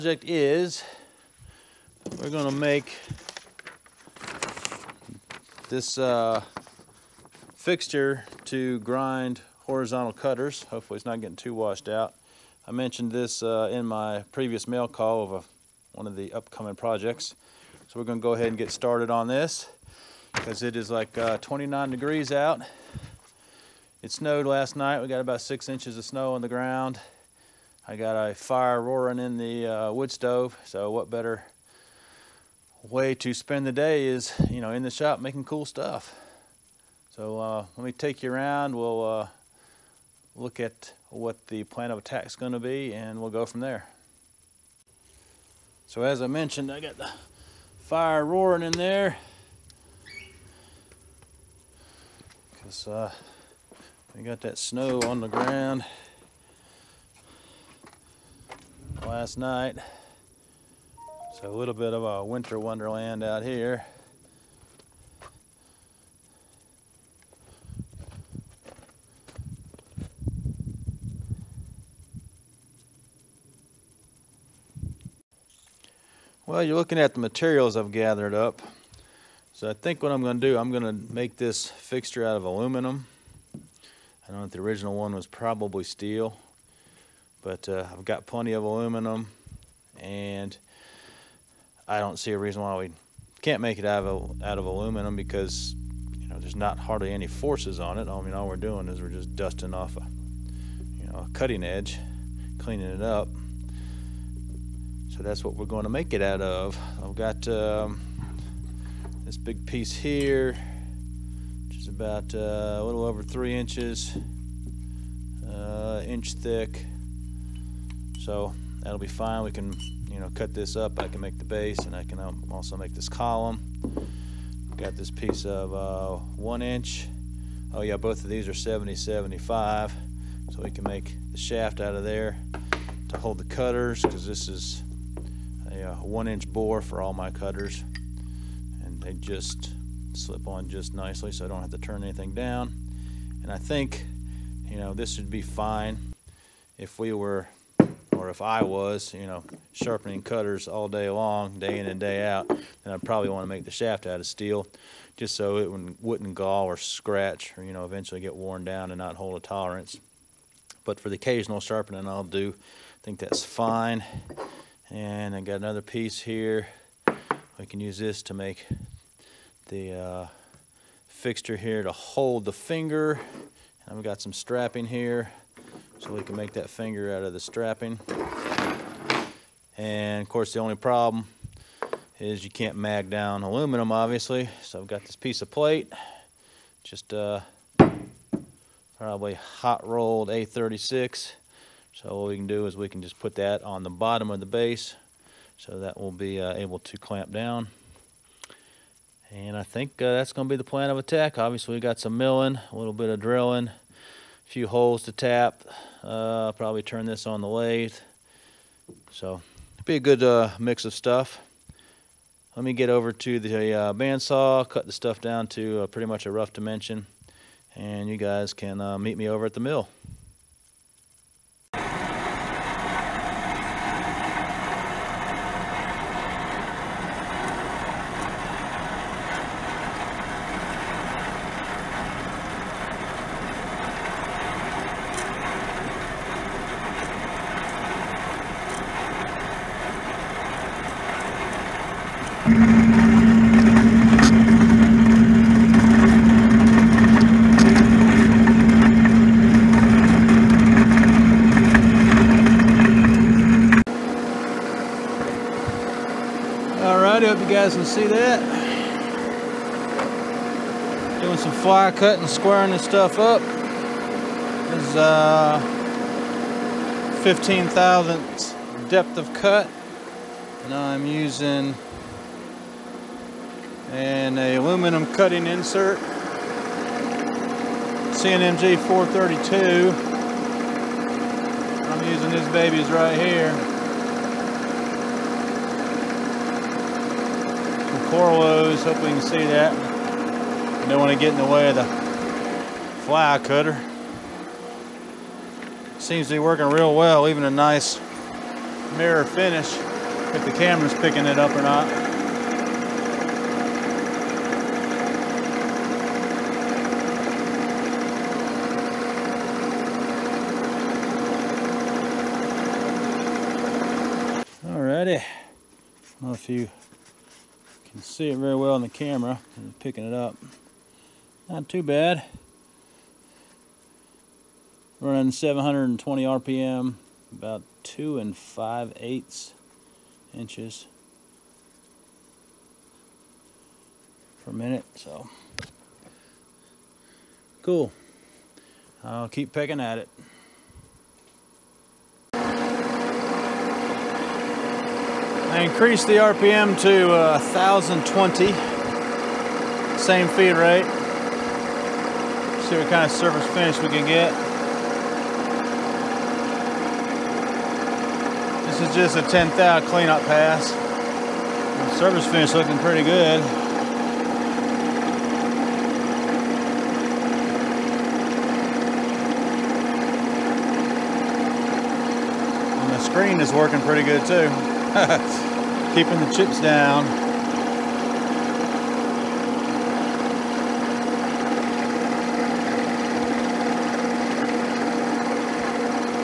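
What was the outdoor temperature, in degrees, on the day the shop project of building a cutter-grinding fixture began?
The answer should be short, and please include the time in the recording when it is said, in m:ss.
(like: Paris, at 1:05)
29, at 0:21.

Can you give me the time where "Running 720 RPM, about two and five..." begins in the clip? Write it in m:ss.
5:25.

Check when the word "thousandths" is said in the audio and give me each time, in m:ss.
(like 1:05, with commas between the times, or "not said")
4:27.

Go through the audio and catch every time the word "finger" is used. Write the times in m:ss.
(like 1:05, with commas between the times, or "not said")
2:52, 2:56.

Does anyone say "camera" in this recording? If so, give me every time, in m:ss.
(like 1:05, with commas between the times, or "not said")
5:00, 5:18.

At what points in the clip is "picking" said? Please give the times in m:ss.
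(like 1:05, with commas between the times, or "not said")
5:00, 5:19, 5:39.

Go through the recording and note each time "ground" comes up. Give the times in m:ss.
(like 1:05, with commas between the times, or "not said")
0:26, 0:55.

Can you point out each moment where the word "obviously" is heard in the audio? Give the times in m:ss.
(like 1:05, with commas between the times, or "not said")
3:03, 3:21.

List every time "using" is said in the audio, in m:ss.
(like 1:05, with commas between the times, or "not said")
4:31, 4:42.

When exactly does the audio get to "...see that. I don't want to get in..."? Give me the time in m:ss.
4:49.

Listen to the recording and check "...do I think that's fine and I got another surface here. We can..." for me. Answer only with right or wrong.
wrong.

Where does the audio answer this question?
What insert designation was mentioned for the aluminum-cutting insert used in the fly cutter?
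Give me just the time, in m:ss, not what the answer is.
4:38.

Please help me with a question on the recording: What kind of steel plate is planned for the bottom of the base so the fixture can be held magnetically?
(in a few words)
hot rolled A36.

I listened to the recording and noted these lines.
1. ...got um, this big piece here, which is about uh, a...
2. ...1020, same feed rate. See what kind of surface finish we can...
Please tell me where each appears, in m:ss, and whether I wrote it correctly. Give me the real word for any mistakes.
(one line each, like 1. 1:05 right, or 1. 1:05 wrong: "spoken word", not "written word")
1. 1:47 right
2. 5:47 right.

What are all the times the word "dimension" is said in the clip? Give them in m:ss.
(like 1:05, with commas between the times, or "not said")
3:36.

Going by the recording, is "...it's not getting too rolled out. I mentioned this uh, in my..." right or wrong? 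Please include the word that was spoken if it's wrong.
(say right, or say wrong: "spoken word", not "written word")
wrong: "washed", not "rolled".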